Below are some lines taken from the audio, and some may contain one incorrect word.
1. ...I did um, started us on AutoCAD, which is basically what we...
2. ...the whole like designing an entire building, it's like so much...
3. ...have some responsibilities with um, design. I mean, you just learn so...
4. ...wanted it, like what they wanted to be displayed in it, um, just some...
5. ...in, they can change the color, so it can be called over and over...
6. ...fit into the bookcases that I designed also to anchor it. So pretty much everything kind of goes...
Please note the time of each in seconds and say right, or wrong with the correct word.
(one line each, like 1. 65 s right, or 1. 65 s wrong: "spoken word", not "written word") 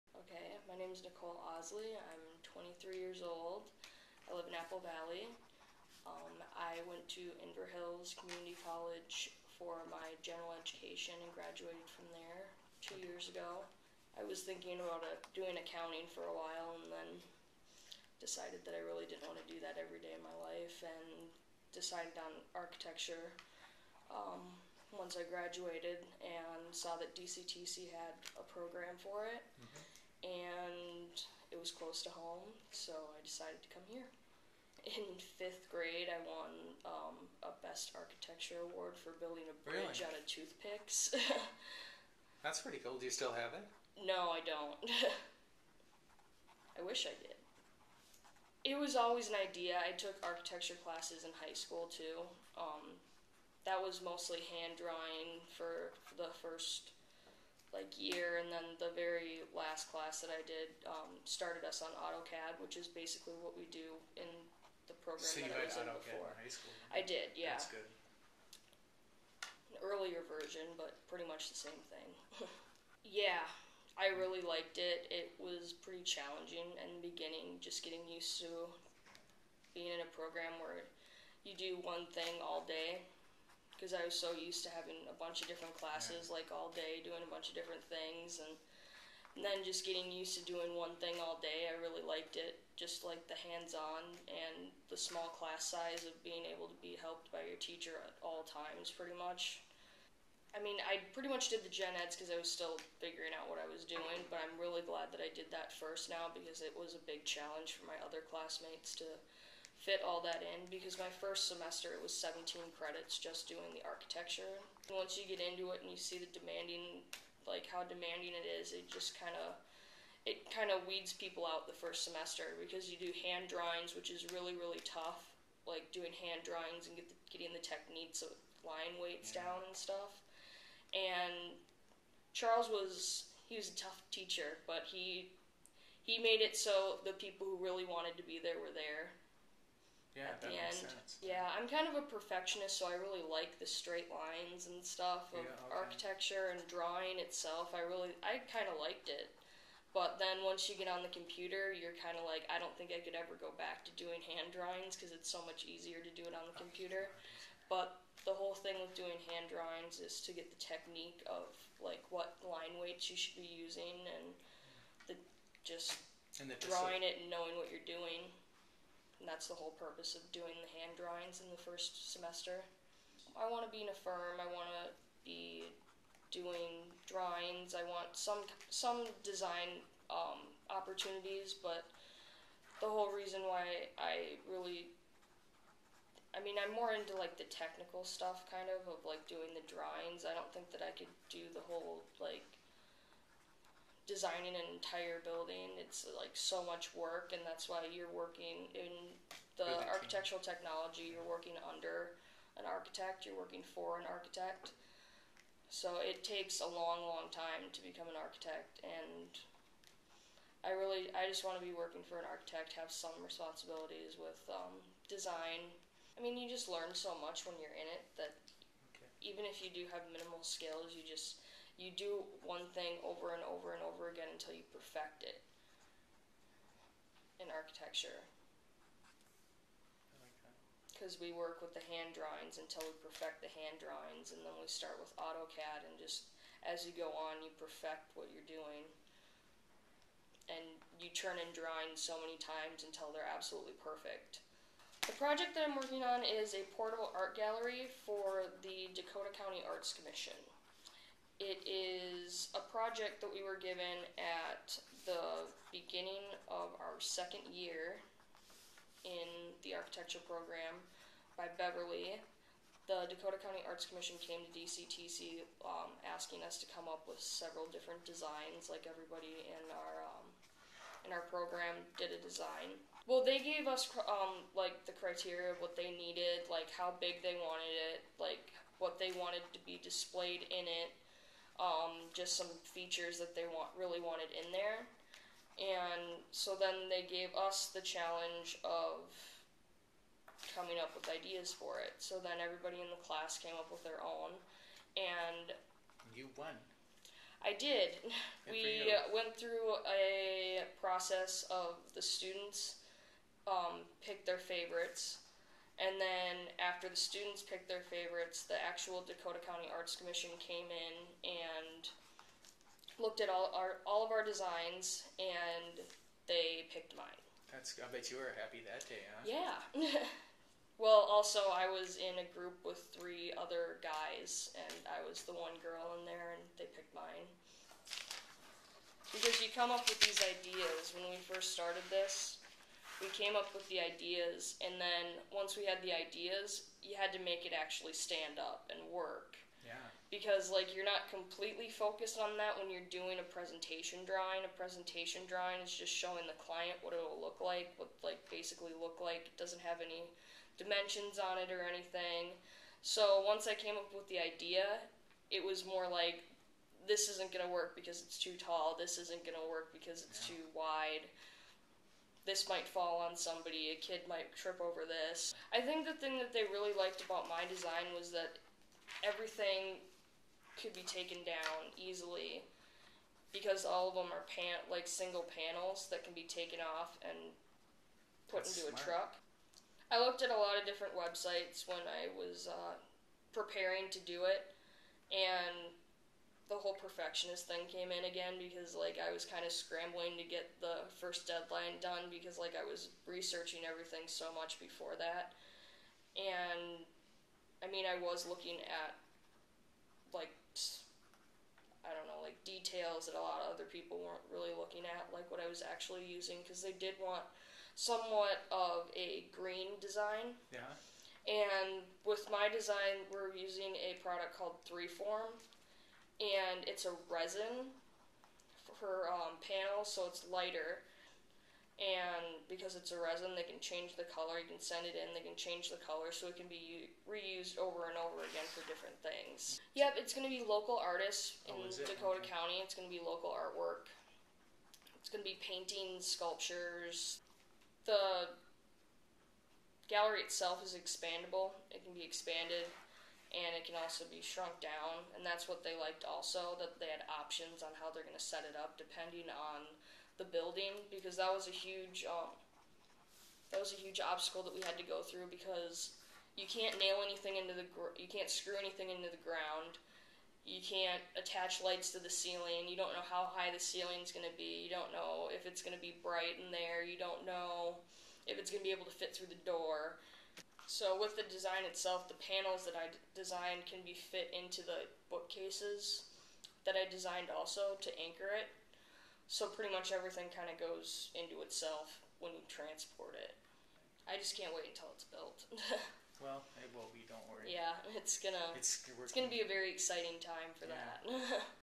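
1. 60 s right
2. 191 s right
3. 212 s right
4. 277 s right
5. 424 s wrong: "reused", not "called"
6. 473 s right.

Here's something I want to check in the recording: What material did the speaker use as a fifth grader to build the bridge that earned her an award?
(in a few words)
Toothpicks.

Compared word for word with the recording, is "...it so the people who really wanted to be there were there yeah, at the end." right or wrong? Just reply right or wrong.
right.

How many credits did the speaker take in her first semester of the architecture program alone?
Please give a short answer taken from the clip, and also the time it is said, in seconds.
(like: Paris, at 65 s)
17, at 112 s.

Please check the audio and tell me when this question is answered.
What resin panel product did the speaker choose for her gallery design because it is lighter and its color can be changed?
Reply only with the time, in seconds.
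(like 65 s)
414 s.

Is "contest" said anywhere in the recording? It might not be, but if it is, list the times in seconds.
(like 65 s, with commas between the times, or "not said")
not said.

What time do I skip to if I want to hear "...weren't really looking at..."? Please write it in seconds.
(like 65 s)
404 s.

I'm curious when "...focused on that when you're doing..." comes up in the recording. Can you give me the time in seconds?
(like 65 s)
341 s.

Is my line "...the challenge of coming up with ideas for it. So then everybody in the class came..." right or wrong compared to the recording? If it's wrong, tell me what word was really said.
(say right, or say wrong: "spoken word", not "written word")
right.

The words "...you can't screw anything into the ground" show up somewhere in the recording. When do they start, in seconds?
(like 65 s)
457 s.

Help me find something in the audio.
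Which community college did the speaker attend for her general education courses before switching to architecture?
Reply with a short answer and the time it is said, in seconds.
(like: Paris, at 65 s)
Inver Hills Community College, at 7 s.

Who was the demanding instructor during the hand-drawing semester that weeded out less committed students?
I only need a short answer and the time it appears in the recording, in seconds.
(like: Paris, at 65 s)
Charles, at 132 s.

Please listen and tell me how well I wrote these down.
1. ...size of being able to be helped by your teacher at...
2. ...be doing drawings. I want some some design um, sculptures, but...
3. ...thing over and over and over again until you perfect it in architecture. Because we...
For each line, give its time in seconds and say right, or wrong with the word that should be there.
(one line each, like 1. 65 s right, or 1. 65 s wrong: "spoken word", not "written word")
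1. 95 s right
2. 175 s wrong: "opportunities", not "sculptures"
3. 222 s right.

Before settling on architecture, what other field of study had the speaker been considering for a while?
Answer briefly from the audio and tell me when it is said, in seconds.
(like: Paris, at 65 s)
Accounting, at 15 s.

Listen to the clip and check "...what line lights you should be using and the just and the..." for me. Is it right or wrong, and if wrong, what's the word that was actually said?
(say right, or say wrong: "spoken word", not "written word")
wrong: "weights", not "lights".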